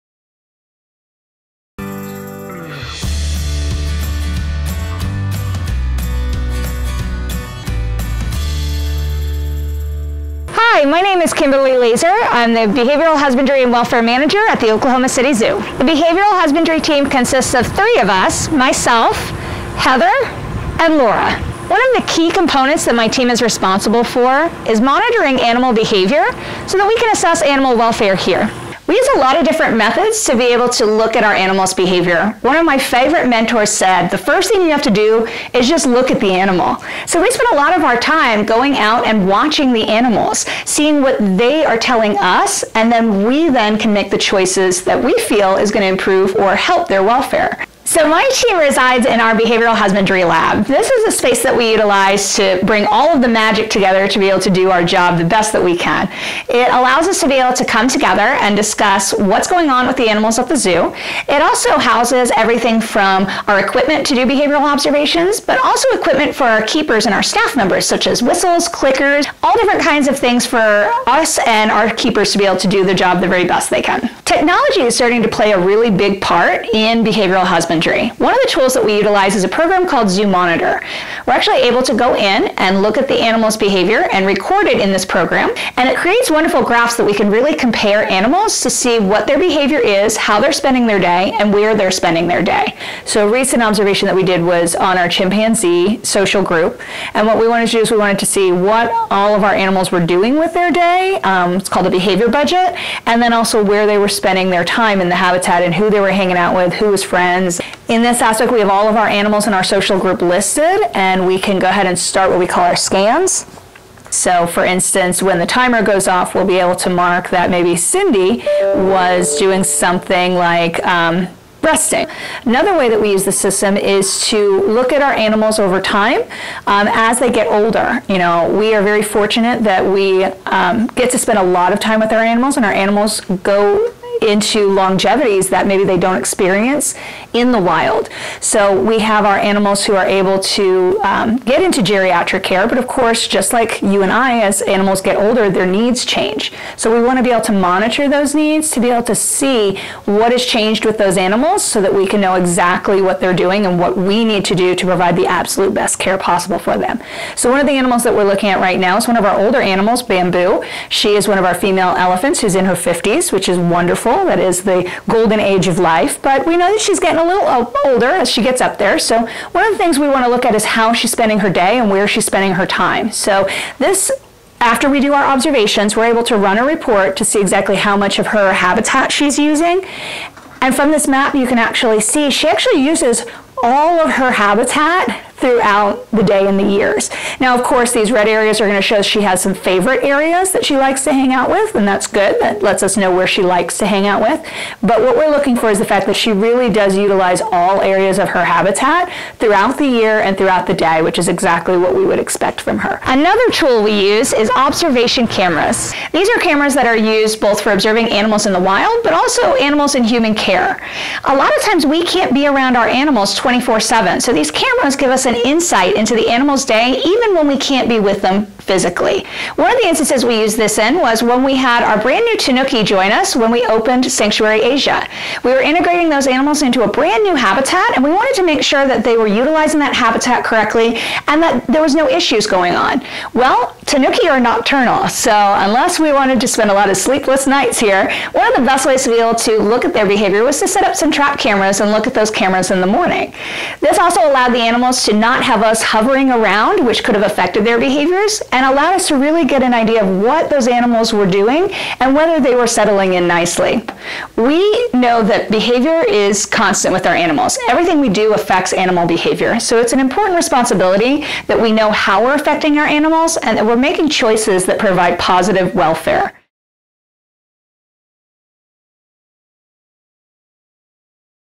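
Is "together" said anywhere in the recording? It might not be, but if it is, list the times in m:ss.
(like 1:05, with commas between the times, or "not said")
0:53, 0:57.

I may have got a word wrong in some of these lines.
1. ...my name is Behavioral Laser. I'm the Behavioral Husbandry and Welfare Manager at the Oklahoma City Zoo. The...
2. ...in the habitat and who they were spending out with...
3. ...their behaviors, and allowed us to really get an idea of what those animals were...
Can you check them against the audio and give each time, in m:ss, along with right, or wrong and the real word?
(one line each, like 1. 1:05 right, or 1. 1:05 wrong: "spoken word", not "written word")
1. 0:10 wrong: "Kimberly", not "Behavioral"
2. 1:45 wrong: "hanging", not "spending"
3. 4:07 right.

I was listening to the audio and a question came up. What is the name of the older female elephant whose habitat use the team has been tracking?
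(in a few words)
Bamboo.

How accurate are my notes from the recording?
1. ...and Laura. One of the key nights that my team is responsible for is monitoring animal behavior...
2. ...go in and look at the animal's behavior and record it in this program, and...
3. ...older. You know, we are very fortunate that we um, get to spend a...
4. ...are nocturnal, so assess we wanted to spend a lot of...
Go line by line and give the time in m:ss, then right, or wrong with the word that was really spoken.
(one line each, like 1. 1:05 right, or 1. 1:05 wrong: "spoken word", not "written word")
1. 0:20 wrong: "components", not "nights"
2. 1:21 right
3. 2:07 right
4. 3:54 wrong: "unless", not "assess".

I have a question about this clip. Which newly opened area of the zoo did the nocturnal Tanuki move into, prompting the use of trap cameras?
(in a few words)
Sanctuary Asia.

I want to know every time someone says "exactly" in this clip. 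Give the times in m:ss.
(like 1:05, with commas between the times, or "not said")
2:32, 2:57, 3:21.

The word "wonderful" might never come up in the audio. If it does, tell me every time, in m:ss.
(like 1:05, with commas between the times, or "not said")
1:26, 2:43.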